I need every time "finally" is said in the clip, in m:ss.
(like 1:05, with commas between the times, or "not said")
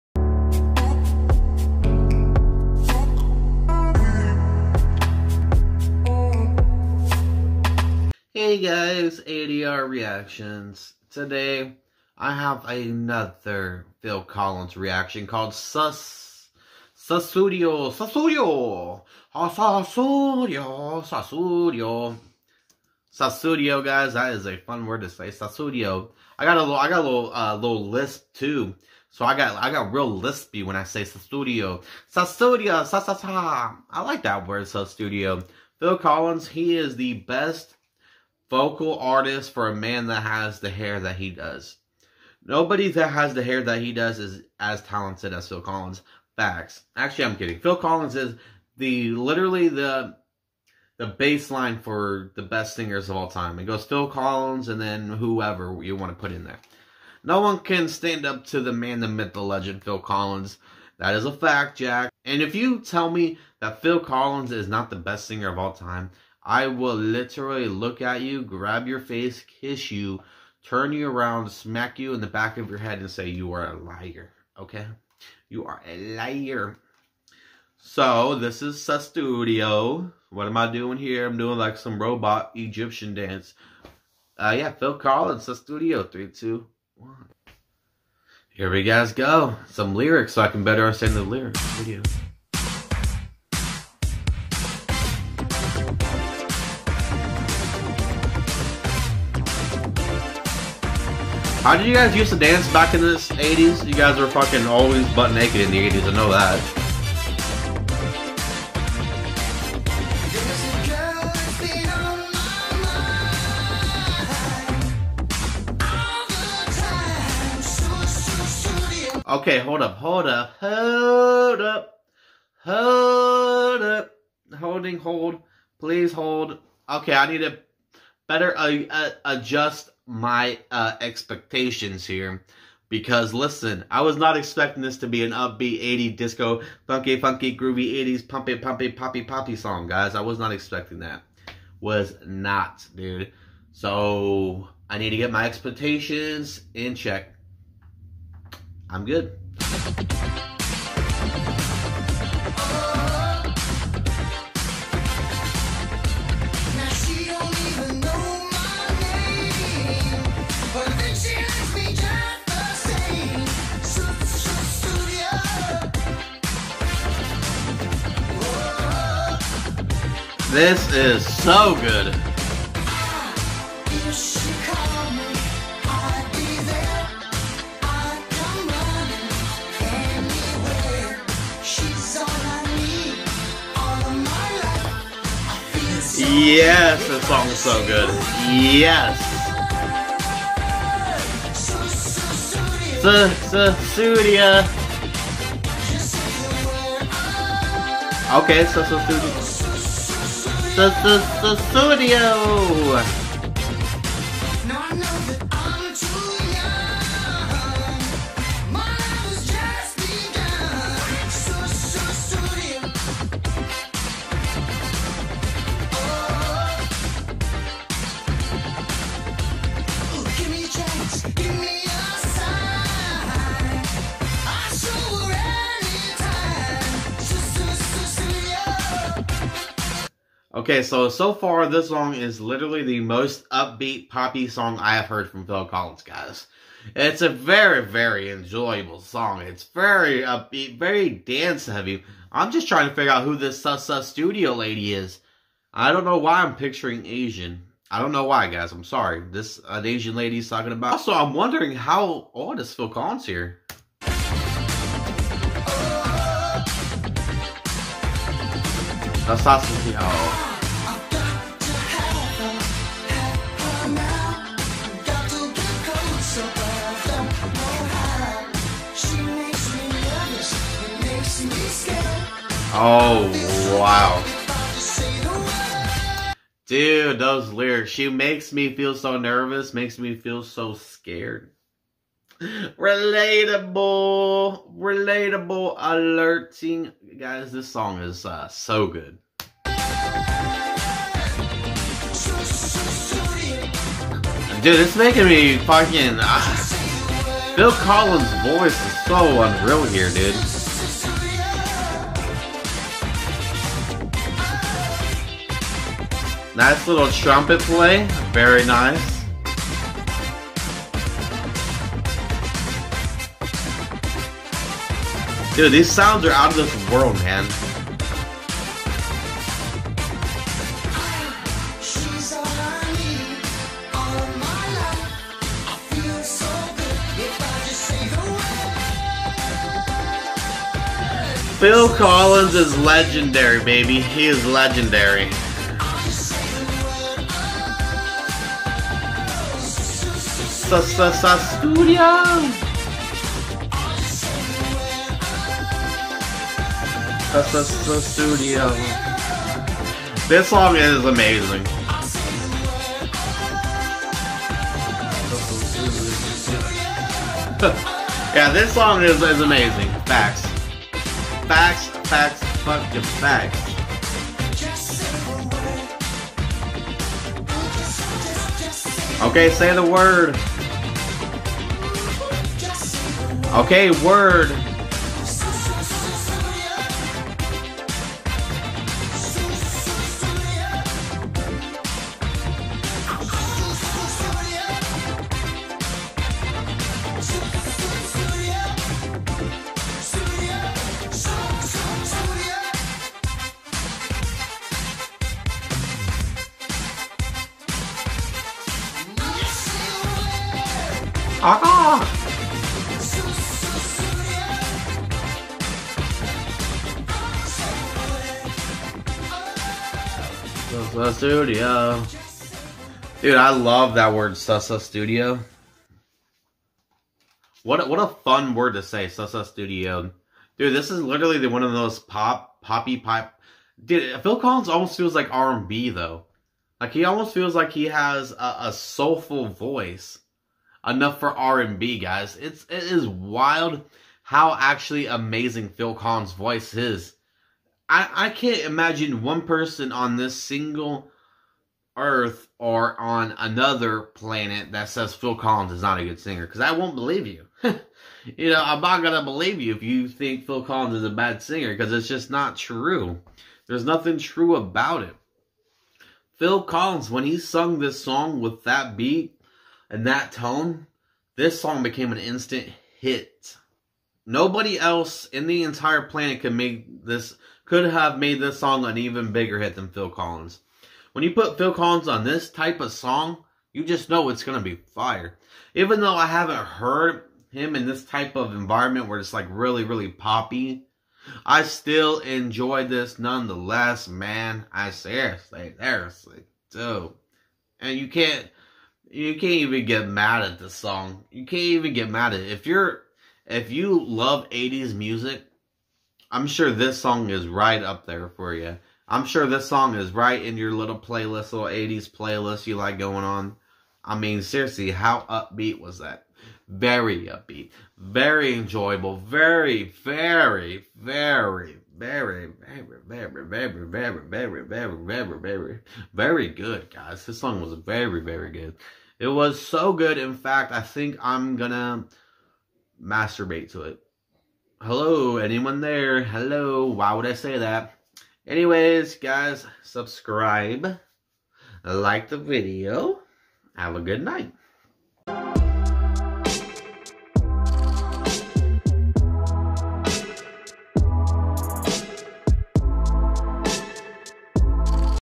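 not said.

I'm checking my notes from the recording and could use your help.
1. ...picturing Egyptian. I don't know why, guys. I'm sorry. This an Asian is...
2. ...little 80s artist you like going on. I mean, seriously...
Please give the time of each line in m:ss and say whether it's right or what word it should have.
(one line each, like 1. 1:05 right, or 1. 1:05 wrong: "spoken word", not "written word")
1. 4:06 wrong: "Asian", not "Egyptian"
2. 8:21 wrong: "playlist", not "artist".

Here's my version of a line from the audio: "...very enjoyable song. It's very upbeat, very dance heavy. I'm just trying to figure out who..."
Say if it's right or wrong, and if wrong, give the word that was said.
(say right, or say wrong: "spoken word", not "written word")
right.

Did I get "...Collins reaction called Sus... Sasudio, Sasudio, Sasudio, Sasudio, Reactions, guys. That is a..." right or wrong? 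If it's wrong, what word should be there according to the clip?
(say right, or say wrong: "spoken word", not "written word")
wrong: "Sasudio", not "Reactions".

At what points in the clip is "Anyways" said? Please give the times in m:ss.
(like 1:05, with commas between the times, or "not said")
8:48.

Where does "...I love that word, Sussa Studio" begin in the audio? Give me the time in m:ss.
6:53.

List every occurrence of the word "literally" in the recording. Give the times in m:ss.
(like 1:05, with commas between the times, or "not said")
0:49, 1:06, 3:52, 7:01.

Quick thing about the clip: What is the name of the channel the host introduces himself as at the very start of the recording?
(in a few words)
ADR Reactions.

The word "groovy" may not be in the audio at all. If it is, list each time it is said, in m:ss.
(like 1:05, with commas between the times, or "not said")
2:17.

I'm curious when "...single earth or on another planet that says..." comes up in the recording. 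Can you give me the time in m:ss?
7:20.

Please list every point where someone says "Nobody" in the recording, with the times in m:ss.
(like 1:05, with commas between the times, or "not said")
0:42, 7:44.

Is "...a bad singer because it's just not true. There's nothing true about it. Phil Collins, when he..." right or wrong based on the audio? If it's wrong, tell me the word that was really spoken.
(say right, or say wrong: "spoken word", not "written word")
right.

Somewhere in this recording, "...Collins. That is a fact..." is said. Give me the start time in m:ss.
0:59.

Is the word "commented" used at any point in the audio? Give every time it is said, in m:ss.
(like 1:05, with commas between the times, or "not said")
not said.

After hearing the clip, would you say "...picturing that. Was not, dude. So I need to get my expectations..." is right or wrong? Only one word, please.
wrong.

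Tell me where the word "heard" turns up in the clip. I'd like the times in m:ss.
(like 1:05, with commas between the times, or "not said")
3:55, 7:56.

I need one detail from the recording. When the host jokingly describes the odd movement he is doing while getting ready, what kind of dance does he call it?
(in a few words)
robot Egyptian dance.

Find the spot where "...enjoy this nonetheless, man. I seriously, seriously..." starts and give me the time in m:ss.
8:02.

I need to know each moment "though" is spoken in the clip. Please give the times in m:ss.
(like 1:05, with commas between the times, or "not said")
7:05, 7:56.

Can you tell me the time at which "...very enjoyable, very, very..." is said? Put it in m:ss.
8:27.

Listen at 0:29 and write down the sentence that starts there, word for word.
So I got, I got real lispy when I say Sasudio, Sasudio, sa I like that word, Sasudio.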